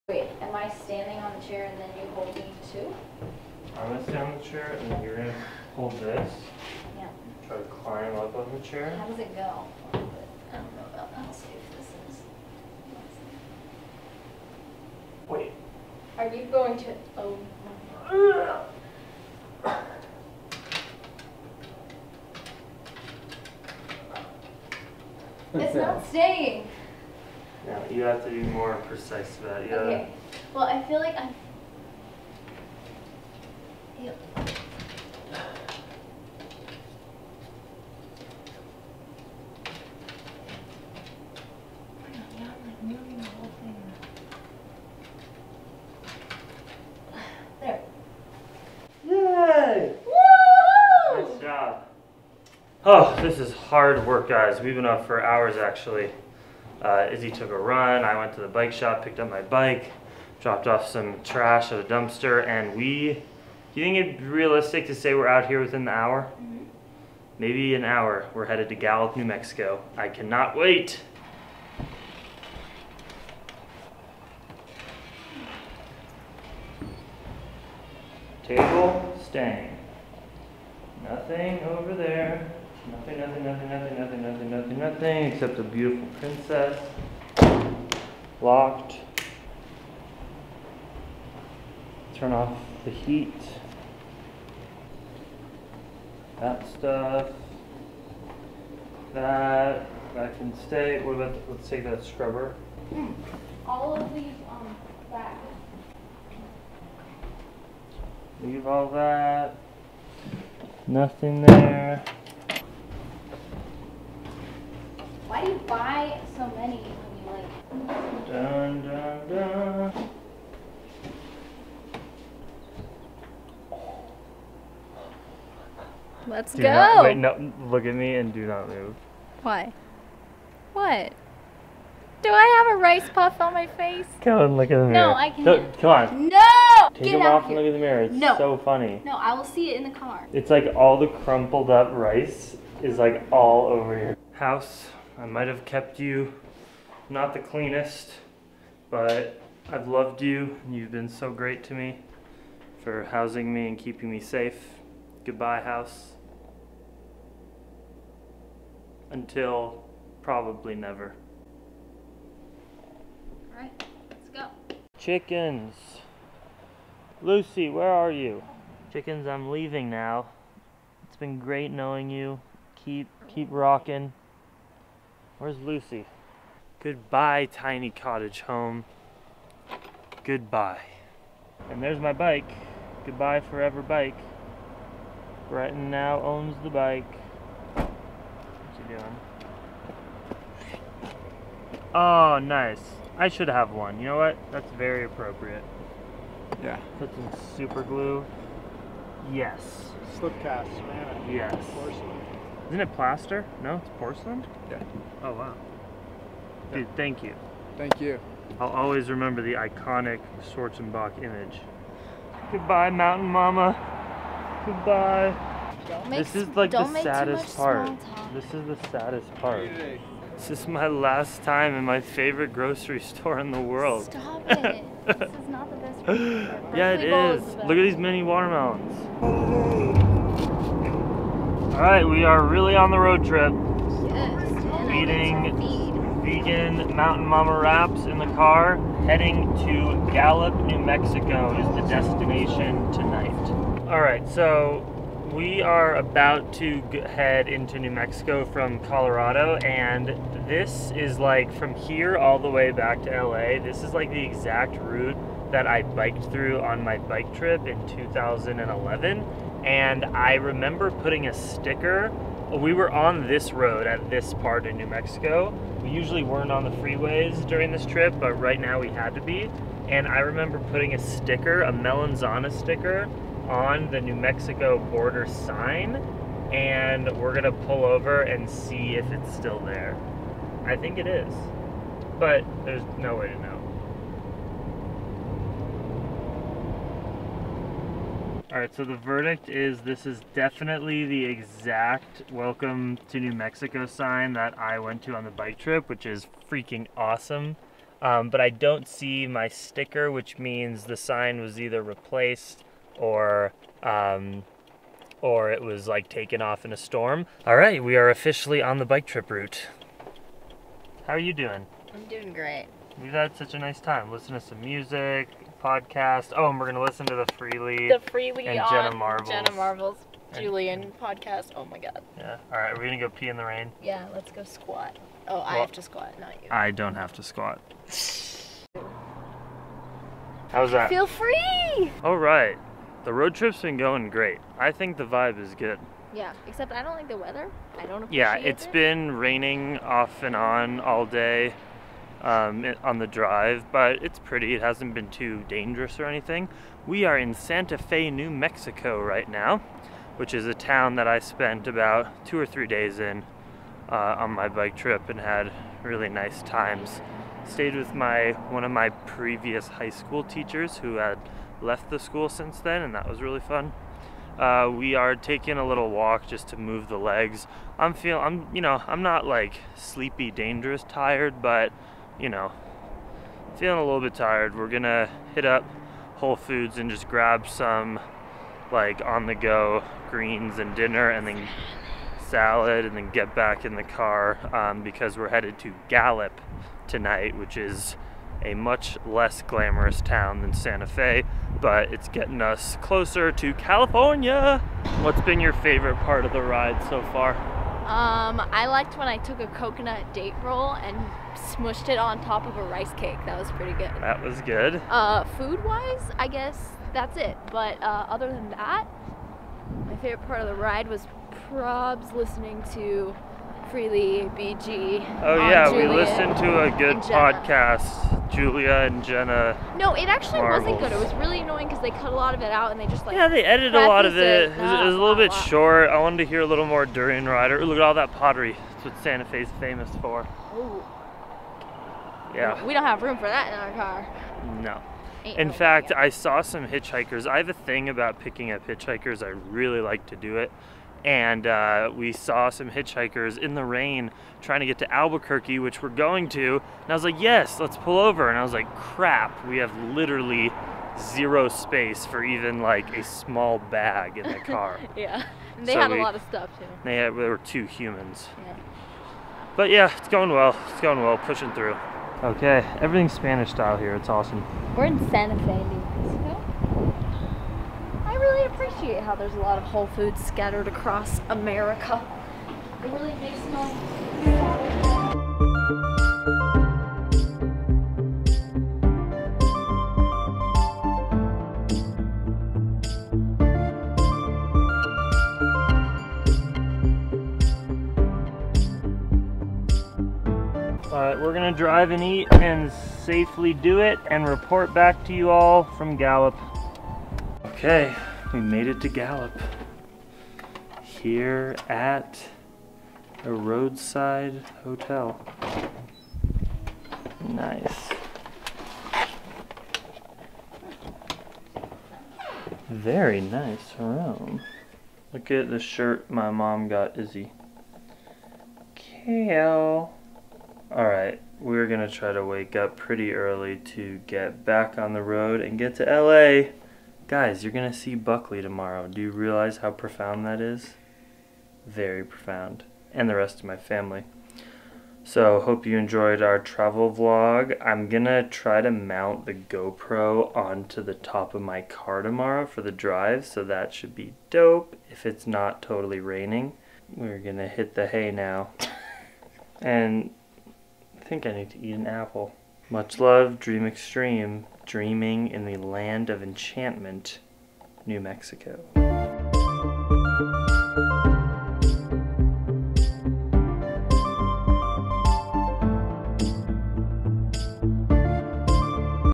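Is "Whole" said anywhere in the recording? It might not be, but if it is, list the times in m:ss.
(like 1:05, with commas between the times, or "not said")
6:16, 7:49.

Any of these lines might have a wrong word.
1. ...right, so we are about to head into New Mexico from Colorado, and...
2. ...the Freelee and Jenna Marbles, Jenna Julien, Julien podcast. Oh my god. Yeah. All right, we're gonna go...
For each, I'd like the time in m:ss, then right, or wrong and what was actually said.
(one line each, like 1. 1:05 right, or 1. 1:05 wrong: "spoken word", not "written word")
1. 4:04 right
2. 5:17 wrong: "Marbles", not "Julien".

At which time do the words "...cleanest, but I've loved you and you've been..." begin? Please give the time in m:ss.
2:27.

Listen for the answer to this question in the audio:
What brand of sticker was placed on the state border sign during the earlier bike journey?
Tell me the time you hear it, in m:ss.
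4:31.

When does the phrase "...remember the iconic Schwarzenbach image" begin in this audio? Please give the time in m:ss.
3:29.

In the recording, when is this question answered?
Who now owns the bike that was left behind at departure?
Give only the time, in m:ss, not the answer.
3:05.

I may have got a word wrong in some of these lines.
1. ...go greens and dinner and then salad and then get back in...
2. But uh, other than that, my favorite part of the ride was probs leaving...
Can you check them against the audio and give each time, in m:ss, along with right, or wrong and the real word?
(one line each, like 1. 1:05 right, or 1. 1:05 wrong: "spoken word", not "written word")
1. 6:19 right
2. 6:47 wrong: "listening", not "leaving".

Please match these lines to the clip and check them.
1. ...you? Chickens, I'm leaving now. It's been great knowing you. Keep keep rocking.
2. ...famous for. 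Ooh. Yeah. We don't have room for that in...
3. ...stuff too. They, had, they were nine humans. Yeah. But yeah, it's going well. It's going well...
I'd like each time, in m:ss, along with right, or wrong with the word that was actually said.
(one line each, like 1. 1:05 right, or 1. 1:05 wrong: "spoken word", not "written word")
1. 2:48 right
2. 7:09 right
3. 7:36 wrong: "two", not "nine".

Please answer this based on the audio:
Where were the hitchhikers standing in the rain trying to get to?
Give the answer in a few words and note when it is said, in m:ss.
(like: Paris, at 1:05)
Albuquerque, at 7:24.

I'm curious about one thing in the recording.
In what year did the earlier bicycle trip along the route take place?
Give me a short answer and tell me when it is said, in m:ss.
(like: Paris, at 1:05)
2011, at 4:17.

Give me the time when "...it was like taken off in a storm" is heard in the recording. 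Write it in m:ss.
5:05.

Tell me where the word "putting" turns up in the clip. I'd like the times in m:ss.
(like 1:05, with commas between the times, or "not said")
4:20, 4:30.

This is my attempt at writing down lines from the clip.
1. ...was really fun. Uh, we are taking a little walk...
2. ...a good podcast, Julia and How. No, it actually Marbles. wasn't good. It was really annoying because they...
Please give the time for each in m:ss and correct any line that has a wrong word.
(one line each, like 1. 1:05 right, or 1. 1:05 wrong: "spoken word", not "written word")
1. 6:03 right
2. 6:56 wrong: "Jenna", not "How".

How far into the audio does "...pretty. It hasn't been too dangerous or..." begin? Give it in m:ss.
5:44.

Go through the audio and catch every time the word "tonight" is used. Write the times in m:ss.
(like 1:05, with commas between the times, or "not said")
4:02, 6:26.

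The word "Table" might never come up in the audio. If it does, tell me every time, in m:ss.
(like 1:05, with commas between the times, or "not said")
1:18.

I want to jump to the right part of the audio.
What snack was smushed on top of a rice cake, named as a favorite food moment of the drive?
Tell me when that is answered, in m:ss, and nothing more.
6:39.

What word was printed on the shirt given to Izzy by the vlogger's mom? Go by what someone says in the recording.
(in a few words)
Kale.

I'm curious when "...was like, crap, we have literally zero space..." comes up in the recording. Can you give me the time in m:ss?
7:28.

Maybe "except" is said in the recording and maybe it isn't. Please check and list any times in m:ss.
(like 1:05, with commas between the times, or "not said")
1:25, 5:36.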